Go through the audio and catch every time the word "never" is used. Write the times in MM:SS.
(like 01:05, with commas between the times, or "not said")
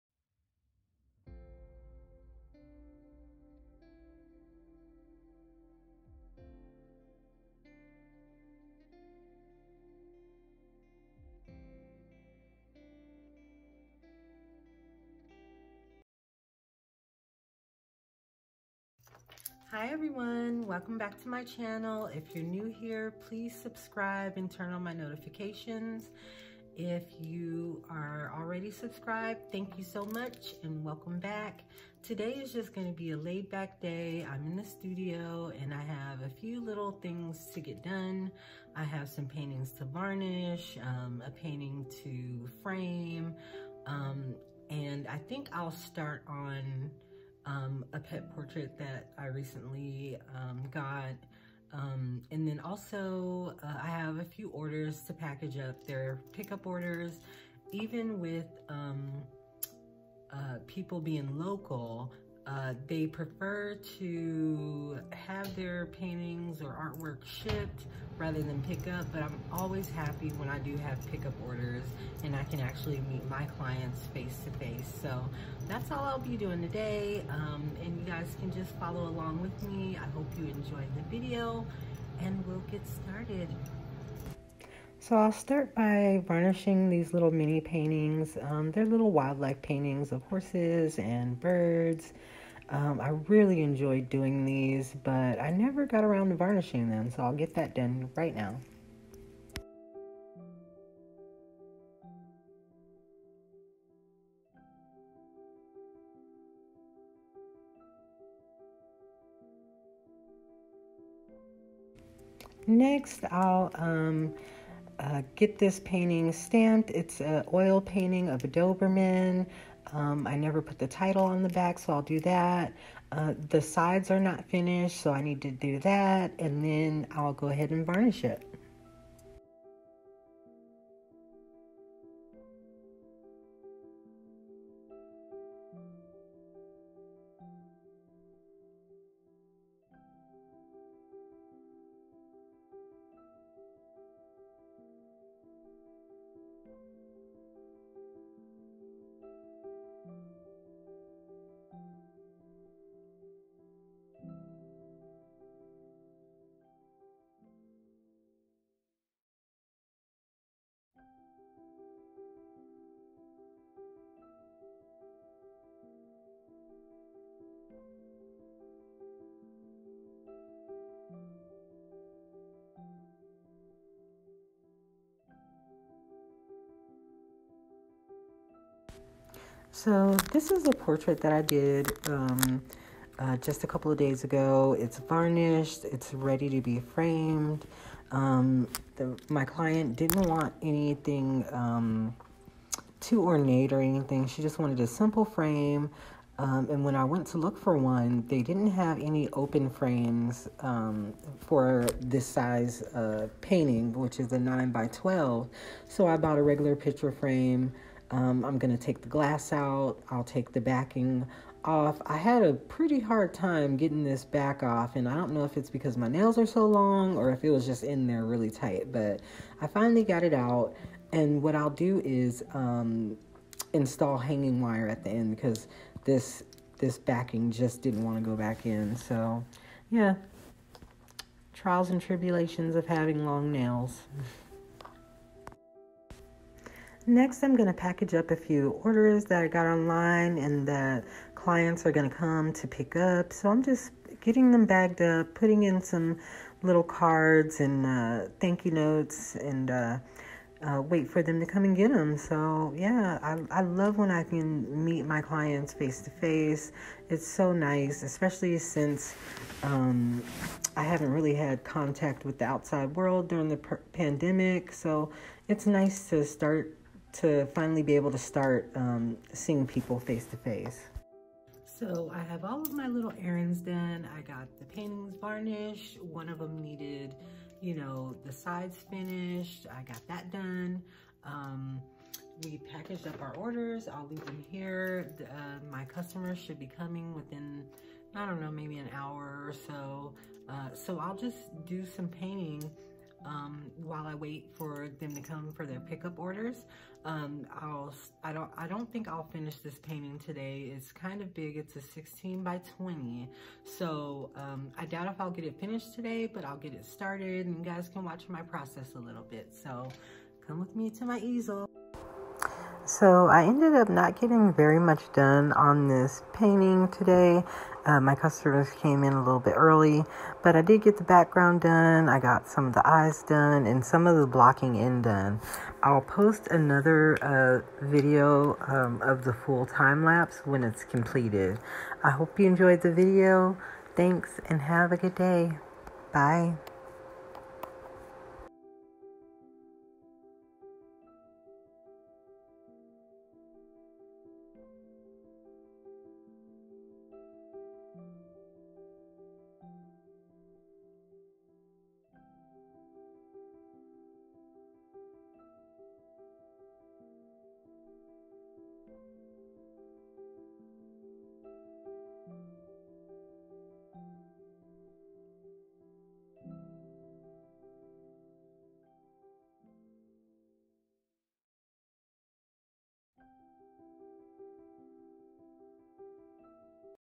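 01:35, 02:00.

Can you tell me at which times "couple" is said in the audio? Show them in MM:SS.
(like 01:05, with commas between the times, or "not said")
03:03.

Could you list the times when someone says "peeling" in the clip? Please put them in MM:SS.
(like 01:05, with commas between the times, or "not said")
not said.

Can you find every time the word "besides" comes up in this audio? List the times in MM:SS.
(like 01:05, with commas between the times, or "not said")
not said.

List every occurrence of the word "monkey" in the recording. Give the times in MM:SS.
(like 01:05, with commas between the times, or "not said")
not said.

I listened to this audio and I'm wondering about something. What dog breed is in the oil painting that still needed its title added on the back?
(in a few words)
Doberman.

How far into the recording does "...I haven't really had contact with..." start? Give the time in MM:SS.
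04:20.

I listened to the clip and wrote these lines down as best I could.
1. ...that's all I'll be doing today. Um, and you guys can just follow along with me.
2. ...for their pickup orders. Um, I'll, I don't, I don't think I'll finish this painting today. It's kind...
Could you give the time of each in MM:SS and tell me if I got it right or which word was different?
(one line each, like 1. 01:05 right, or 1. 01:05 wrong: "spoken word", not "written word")
1. 01:15 right
2. 04:55 right.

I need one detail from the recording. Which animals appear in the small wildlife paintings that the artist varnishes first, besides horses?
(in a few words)
birds.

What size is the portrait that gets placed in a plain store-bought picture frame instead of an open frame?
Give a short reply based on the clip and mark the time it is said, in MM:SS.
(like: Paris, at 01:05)
9 by 12, at 03:24.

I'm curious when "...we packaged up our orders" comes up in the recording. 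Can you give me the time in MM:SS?
04:42.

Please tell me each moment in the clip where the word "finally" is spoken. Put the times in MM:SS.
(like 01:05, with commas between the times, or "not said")
03:39, 04:27.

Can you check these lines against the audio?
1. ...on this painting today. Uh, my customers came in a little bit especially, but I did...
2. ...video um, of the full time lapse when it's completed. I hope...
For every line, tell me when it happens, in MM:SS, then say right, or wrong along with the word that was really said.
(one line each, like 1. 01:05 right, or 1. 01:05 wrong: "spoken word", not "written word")
1. 05:15 wrong: "early", not "especially"
2. 05:27 right.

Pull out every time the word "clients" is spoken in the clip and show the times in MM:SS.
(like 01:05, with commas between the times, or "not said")
01:13, 03:09, 04:01, 04:15.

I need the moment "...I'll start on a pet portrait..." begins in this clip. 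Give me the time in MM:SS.
00:45.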